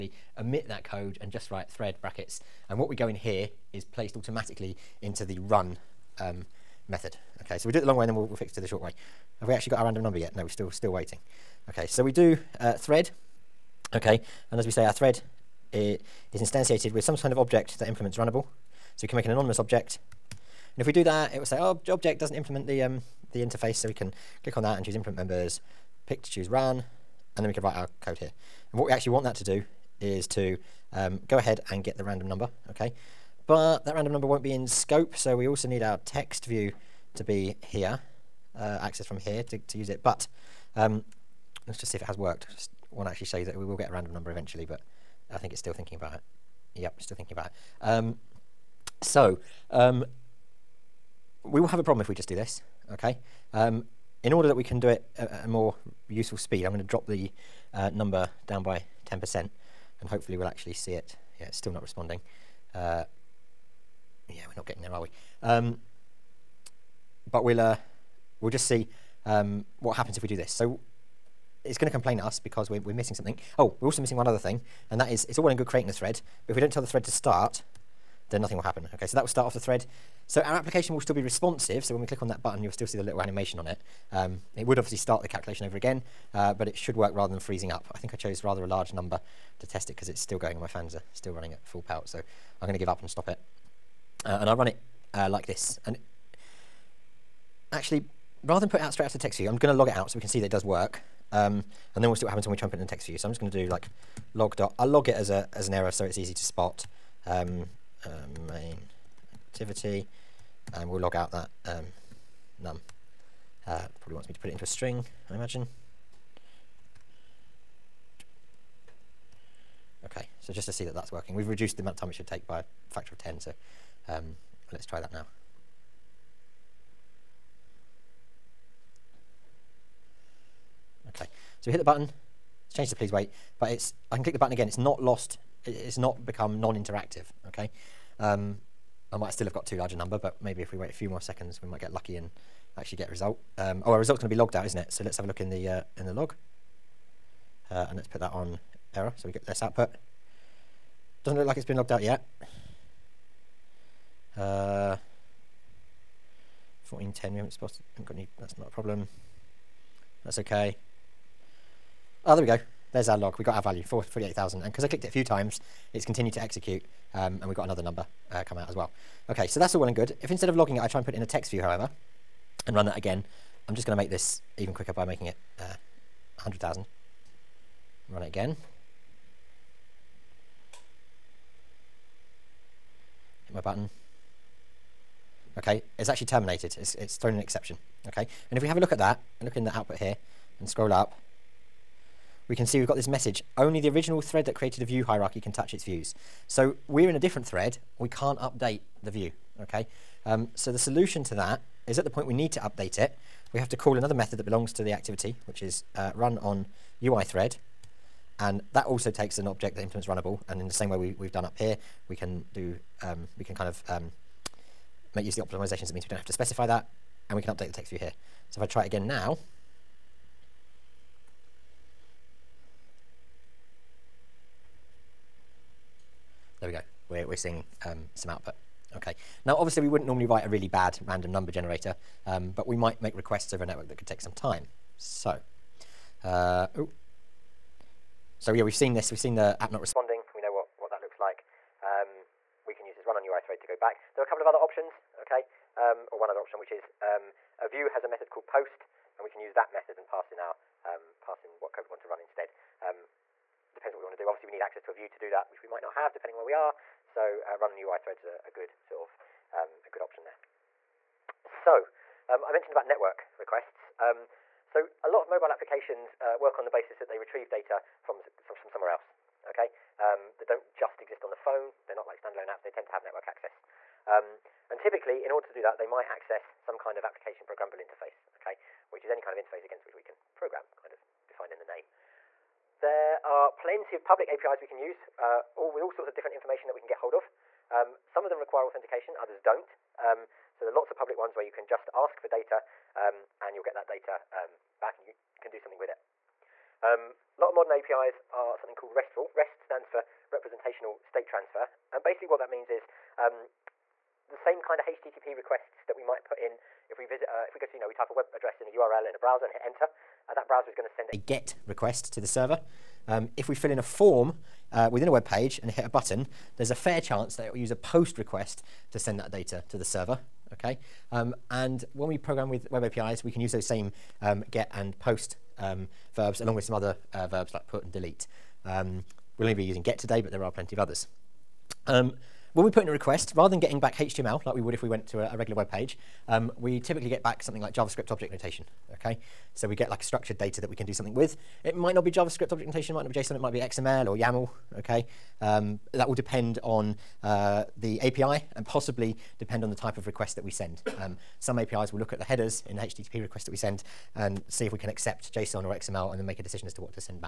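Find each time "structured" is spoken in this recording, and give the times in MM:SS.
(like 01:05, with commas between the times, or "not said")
05:40.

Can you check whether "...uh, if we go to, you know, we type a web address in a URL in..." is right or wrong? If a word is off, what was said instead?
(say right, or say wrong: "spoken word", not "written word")
right.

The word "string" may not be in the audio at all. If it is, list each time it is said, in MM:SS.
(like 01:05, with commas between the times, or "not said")
01:54.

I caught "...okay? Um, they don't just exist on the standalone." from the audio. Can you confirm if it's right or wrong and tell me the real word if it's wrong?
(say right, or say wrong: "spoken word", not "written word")
wrong: "phone", not "standalone".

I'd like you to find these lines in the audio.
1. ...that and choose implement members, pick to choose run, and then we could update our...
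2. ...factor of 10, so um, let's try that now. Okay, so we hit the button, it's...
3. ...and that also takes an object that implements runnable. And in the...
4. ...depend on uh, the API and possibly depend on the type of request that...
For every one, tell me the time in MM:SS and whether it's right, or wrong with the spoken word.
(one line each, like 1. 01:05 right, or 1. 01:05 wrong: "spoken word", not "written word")
1. 00:24 wrong: "write", not "update"
2. 02:02 right
3. 03:28 right
4. 05:46 right.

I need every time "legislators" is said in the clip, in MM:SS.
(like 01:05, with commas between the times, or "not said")
not said.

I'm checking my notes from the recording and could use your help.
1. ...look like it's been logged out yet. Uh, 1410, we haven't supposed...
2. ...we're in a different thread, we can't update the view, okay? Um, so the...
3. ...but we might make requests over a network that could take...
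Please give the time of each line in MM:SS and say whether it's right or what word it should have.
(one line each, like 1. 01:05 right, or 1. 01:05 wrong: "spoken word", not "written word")
1. 02:31 right
2. 03:16 right
3. 03:52 right.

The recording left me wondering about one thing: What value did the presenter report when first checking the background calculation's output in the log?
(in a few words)
48,000.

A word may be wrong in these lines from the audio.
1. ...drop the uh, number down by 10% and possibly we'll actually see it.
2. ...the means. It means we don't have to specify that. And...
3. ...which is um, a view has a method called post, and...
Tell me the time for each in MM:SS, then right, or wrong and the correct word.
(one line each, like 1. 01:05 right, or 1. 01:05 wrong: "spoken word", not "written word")
1. 00:56 wrong: "hopefully", not "possibly"
2. 03:35 wrong: "optimizations", not "means"
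3. 04:06 right.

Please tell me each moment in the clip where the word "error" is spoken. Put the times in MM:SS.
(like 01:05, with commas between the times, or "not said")
01:45, 02:28.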